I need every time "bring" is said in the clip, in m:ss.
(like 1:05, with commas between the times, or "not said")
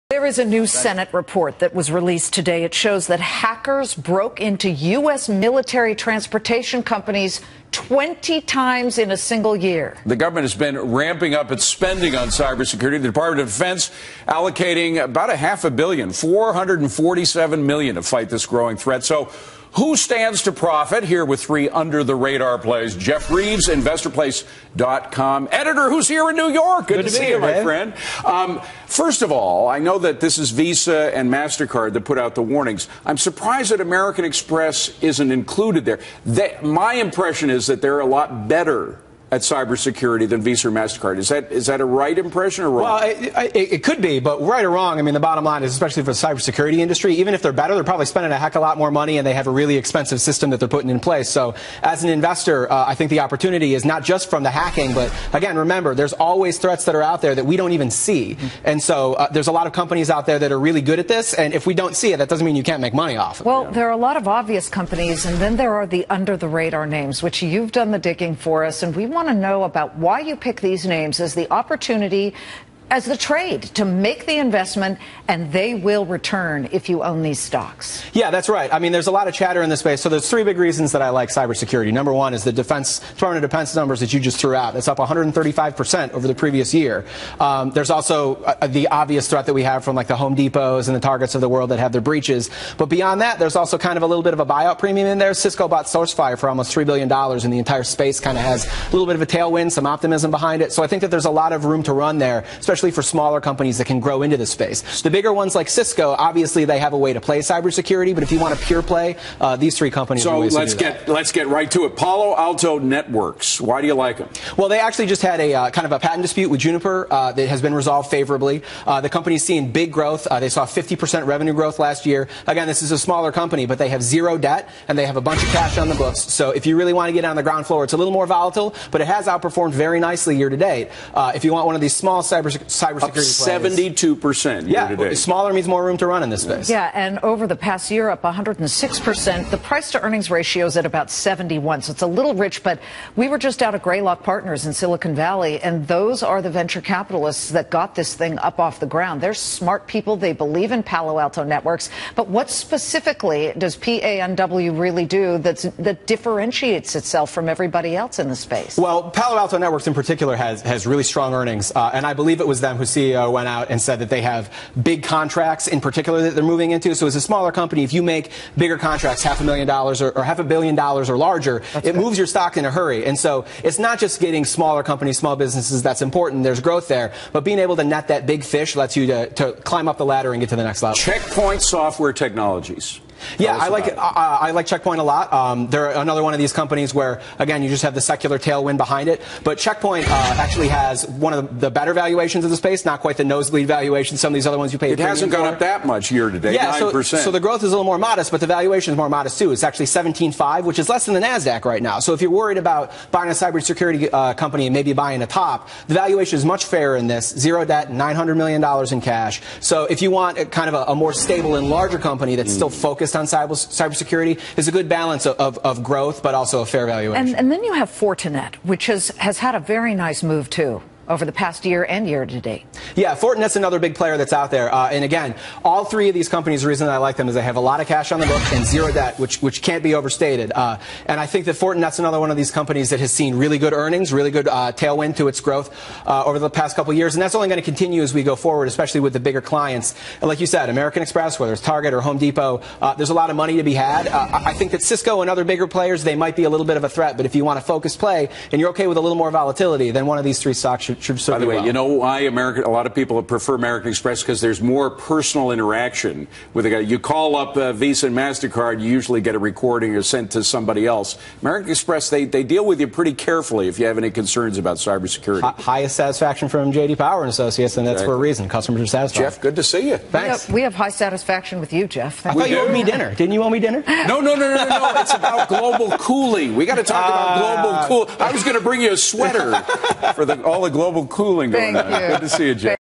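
4:38.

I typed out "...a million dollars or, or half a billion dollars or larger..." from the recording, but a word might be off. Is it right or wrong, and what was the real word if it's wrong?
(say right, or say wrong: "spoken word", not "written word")
right.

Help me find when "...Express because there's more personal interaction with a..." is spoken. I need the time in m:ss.
4:13.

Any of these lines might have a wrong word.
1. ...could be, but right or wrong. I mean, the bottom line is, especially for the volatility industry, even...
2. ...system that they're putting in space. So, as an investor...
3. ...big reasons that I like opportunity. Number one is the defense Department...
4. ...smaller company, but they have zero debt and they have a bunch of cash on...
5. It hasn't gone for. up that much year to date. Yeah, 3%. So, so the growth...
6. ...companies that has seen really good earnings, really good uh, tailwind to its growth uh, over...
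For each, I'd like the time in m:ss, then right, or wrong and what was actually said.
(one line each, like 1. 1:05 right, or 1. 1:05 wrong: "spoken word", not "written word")
1. 0:43 wrong: "cybersecurity", not "volatility"
2. 0:50 wrong: "place", not "space"
3. 1:20 wrong: "cybersecurity", not "opportunity"
4. 2:02 right
5. 3:14 wrong: "9", not "3"
6. 3:52 right.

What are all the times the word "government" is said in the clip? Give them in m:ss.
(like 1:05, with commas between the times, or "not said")
0:10.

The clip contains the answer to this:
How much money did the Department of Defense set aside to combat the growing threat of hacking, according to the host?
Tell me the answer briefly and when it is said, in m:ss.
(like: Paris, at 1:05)
447 million, at 0:16.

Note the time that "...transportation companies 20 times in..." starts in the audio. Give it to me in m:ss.
0:05.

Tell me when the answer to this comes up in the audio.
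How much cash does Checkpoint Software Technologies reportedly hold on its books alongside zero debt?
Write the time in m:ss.
3:27.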